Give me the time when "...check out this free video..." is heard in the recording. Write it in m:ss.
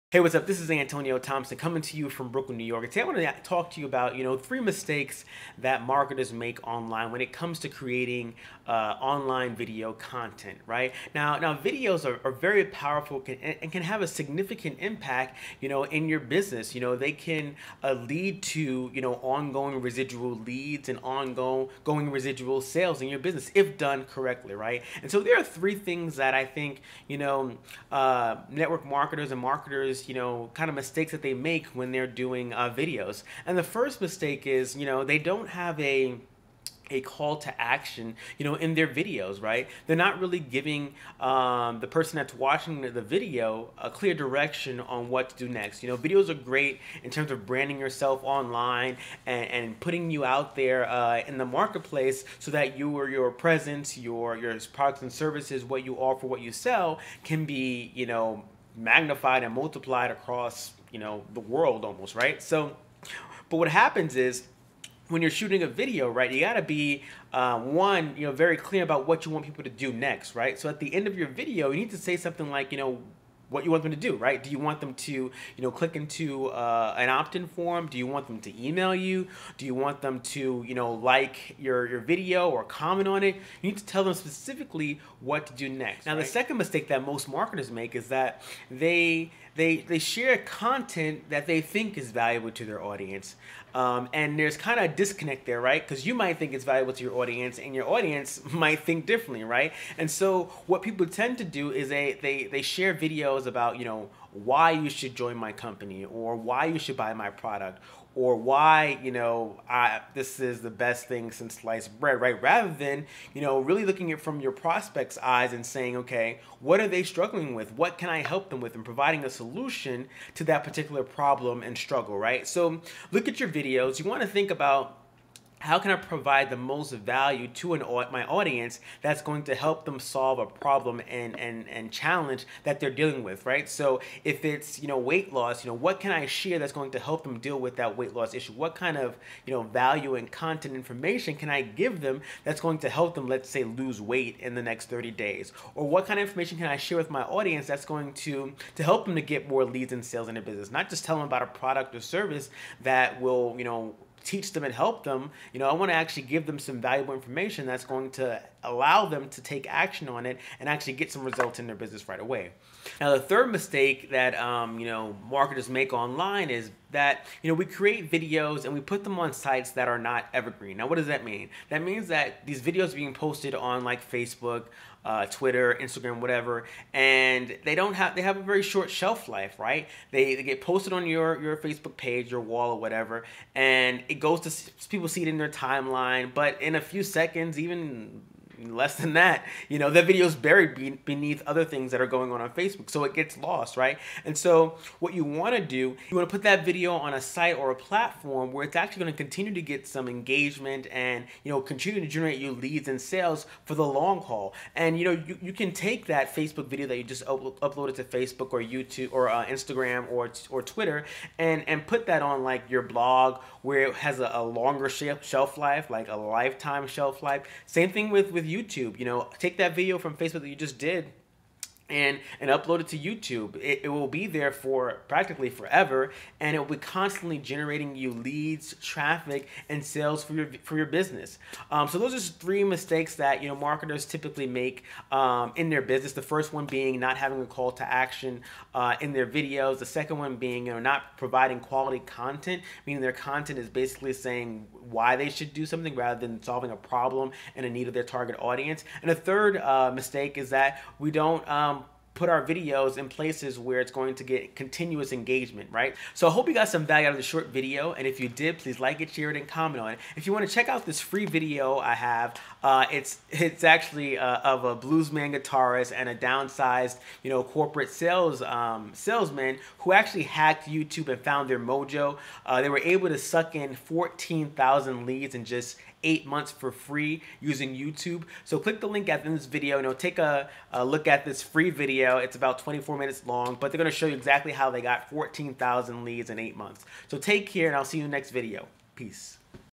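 4:20.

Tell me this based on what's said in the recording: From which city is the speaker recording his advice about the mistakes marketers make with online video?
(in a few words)
Brooklyn, New York.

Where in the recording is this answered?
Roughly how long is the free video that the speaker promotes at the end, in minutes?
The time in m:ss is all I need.
4:42.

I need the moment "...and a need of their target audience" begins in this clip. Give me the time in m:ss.
4:07.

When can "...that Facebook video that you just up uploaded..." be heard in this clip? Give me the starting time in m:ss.
3:26.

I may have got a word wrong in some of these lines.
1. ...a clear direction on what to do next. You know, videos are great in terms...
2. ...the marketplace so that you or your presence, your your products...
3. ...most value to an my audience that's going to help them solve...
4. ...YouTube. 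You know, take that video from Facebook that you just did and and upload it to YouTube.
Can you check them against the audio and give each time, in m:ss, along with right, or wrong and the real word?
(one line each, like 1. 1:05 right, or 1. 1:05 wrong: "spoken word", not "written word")
1. 0:43 right
2. 0:51 right
3. 2:06 right
4. 3:38 right.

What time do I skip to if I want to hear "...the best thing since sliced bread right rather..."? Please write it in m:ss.
1:50.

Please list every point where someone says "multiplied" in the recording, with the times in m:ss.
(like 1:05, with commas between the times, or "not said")
0:59.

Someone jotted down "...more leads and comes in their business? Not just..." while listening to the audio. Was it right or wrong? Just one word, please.
wrong.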